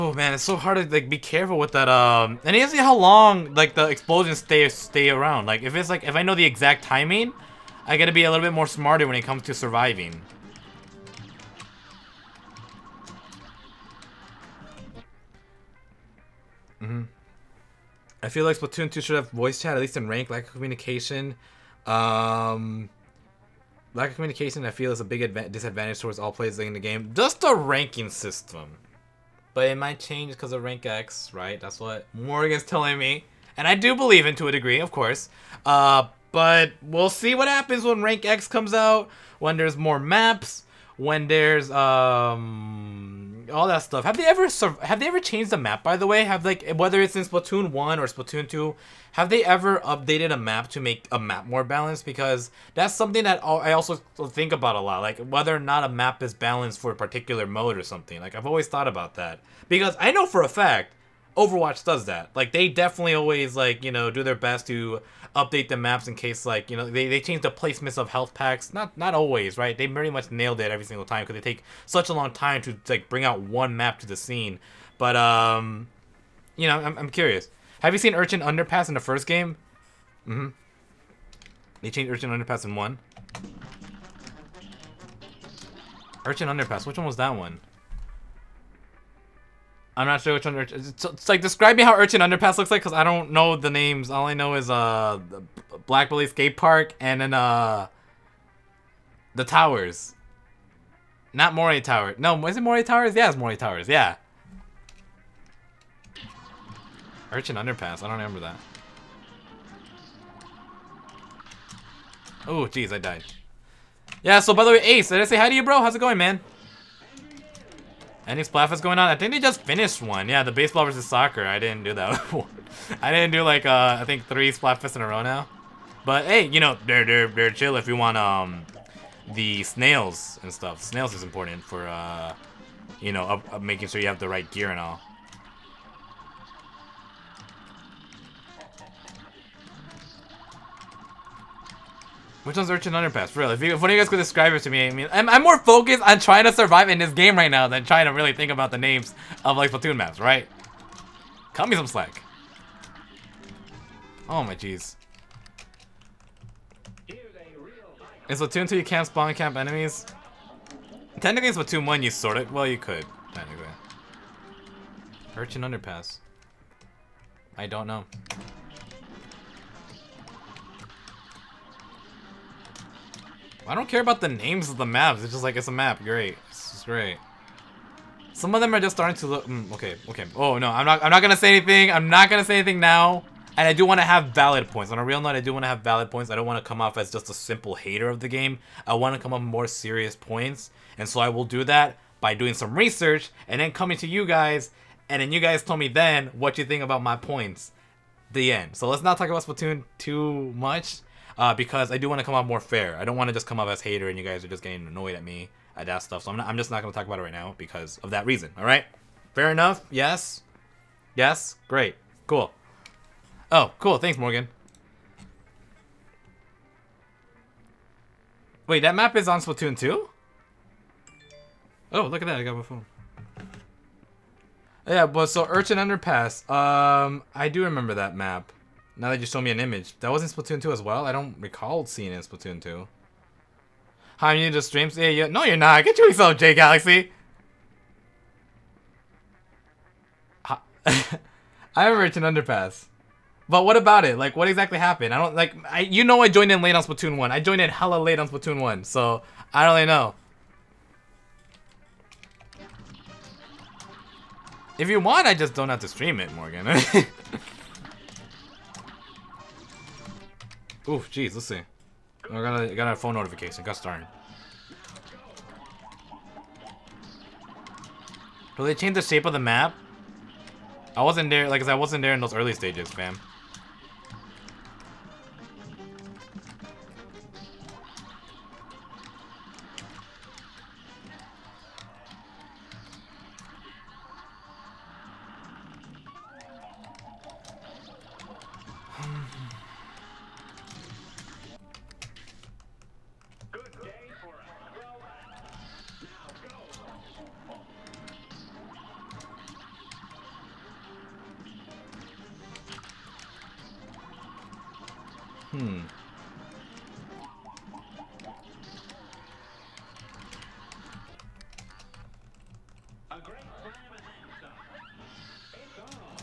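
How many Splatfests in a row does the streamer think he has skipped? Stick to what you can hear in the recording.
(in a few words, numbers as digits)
3.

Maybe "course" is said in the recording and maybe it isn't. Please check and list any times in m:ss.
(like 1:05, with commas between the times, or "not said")
0:34.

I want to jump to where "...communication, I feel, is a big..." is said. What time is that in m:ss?
0:24.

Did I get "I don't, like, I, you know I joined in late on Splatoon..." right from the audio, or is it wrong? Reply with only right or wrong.
right.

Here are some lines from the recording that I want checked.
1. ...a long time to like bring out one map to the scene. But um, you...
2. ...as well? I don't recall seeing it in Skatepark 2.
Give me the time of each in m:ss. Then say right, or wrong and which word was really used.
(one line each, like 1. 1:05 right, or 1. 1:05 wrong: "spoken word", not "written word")
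1. 1:12 right
2. 3:50 wrong: "Splatoon", not "Skatepark".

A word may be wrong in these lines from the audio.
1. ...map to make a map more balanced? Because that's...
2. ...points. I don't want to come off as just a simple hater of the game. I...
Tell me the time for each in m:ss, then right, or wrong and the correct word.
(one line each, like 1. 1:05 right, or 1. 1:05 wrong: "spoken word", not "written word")
1. 0:50 right
2. 3:06 right.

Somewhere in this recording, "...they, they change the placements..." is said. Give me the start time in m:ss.
1:06.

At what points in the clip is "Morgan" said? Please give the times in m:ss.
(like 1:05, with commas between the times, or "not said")
0:32, 3:34, 4:16.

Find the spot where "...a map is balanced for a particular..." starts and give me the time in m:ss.
0:55.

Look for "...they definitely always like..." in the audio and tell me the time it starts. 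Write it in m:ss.
1:02.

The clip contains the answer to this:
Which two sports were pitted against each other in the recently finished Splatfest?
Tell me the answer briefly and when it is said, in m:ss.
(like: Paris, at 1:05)
Baseball versus soccer, at 2:00.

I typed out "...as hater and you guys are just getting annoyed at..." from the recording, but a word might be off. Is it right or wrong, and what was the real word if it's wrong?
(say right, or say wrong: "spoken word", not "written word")
right.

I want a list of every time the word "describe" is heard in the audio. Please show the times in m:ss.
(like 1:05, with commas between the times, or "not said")
1:31, 2:24.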